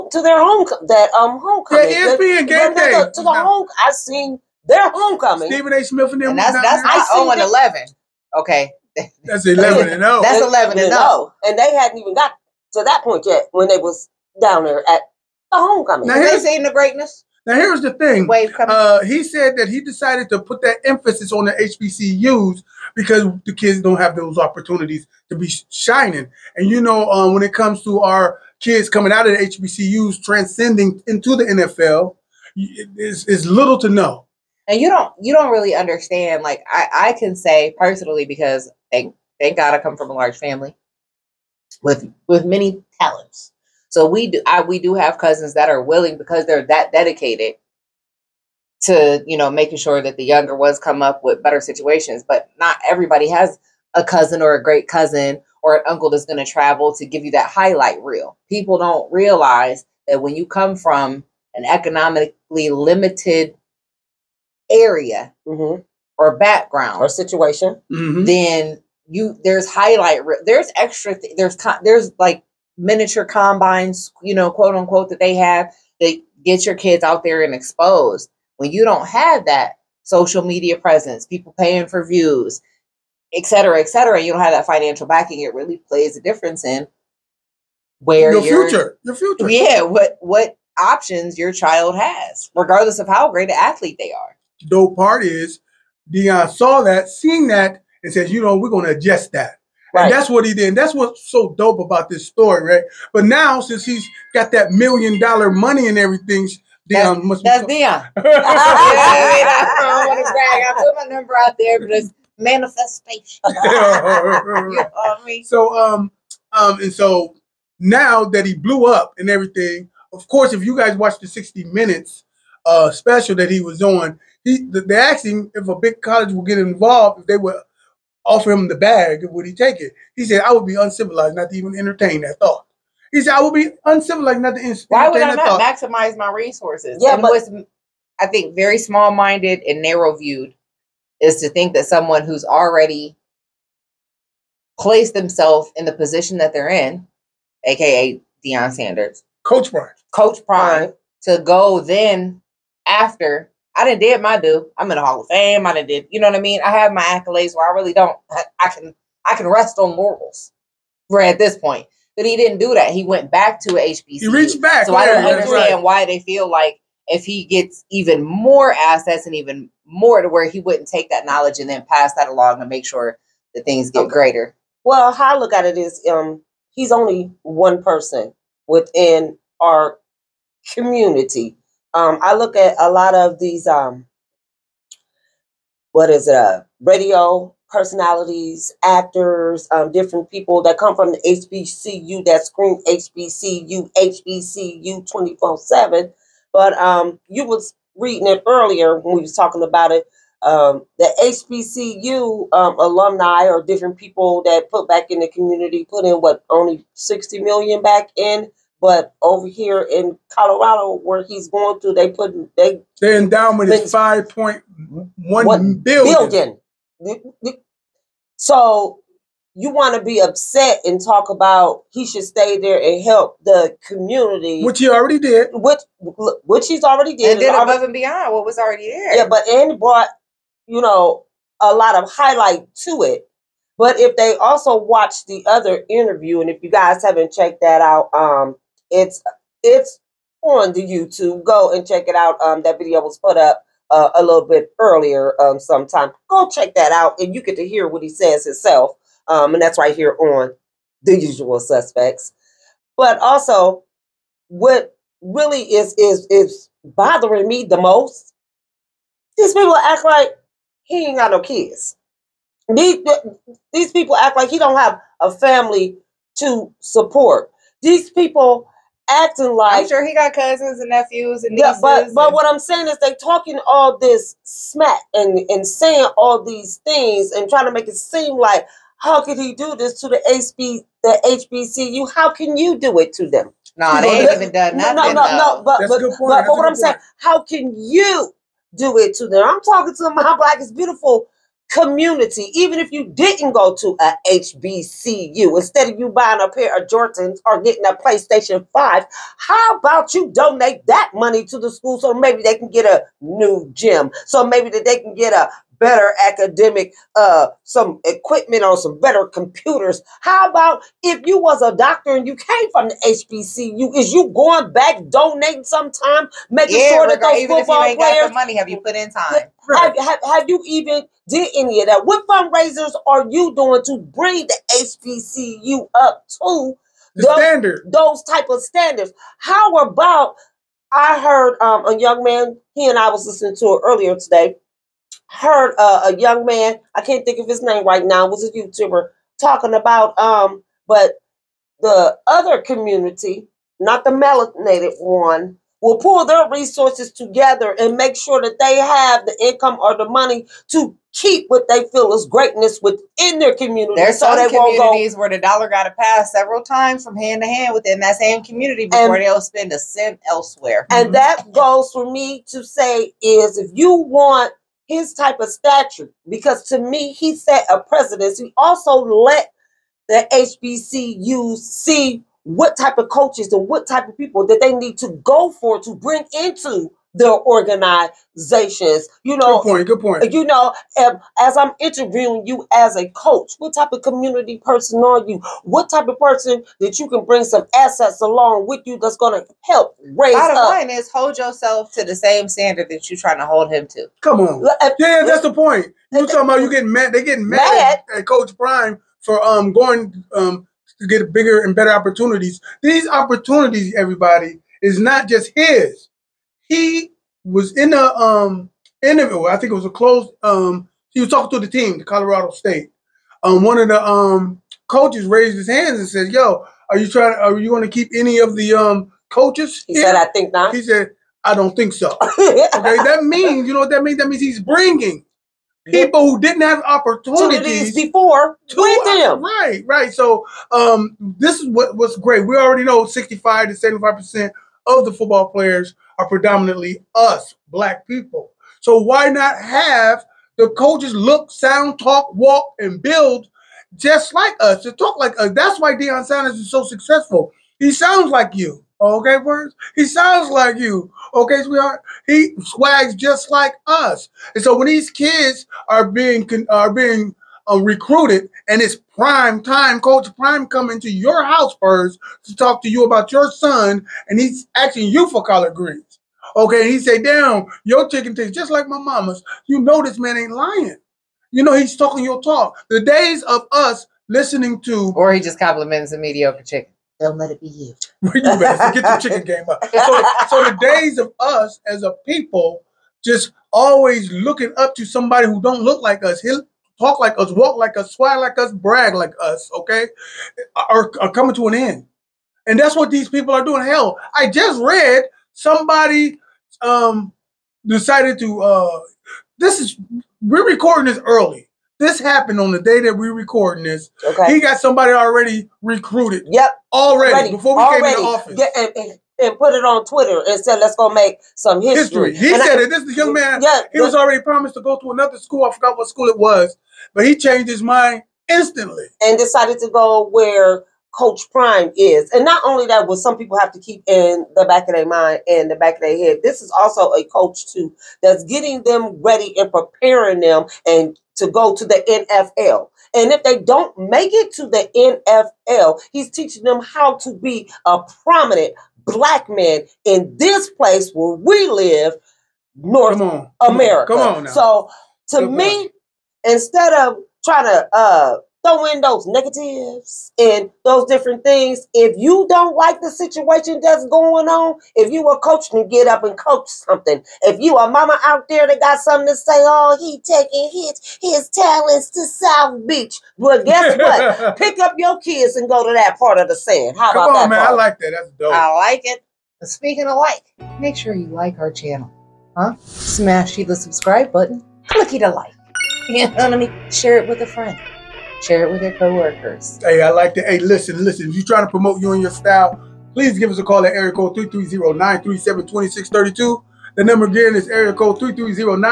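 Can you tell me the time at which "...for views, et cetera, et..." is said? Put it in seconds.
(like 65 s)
81 s.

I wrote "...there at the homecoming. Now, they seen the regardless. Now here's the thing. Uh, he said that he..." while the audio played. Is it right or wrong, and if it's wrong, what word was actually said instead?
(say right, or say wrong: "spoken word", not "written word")
wrong: "greatness", not "regardless".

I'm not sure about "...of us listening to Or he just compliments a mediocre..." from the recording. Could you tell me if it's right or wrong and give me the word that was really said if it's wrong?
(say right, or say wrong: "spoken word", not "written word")
right.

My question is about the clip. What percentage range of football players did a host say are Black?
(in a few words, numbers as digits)
65 to 75 percent.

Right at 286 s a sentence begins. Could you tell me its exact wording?
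saying, how can you do it to them?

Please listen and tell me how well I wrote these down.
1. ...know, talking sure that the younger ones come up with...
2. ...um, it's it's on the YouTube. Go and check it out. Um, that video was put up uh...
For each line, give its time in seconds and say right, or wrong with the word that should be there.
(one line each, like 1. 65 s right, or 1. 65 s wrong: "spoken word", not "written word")
1. 49 s wrong: "making", not "talking"
2. 238 s right.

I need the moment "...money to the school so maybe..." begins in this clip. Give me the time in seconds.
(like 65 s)
301 s.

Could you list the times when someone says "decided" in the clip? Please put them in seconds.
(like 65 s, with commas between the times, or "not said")
19 s, 497 s, 519 s.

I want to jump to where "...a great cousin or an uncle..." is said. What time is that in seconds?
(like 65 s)
54 s.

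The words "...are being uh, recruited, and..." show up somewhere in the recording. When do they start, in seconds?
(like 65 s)
456 s.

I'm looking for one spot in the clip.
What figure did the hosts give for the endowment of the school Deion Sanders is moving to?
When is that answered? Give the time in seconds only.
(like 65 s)
213 s.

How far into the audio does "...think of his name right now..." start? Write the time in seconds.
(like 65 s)
337 s.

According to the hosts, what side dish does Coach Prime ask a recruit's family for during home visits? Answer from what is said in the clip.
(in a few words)
Collard greens.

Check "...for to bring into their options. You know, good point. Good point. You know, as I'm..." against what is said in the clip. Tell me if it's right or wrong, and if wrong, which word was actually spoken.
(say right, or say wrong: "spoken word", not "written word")
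wrong: "organizations", not "options".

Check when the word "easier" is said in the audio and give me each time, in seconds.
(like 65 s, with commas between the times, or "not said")
not said.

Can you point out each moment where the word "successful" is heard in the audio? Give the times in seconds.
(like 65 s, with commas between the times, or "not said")
446 s.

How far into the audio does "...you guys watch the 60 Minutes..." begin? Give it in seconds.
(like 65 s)
120 s.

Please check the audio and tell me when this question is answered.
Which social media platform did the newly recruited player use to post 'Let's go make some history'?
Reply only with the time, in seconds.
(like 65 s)
510 s.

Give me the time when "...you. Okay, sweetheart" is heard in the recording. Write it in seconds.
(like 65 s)
450 s.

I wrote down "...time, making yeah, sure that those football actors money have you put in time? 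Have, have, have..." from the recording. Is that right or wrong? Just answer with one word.
wrong.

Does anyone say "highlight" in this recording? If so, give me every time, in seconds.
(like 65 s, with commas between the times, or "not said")
57 s, 69 s, 232 s.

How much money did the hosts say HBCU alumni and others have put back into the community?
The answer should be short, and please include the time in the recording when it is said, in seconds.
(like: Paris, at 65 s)
60 million, at 206 s.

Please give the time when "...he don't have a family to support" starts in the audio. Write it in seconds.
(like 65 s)
264 s.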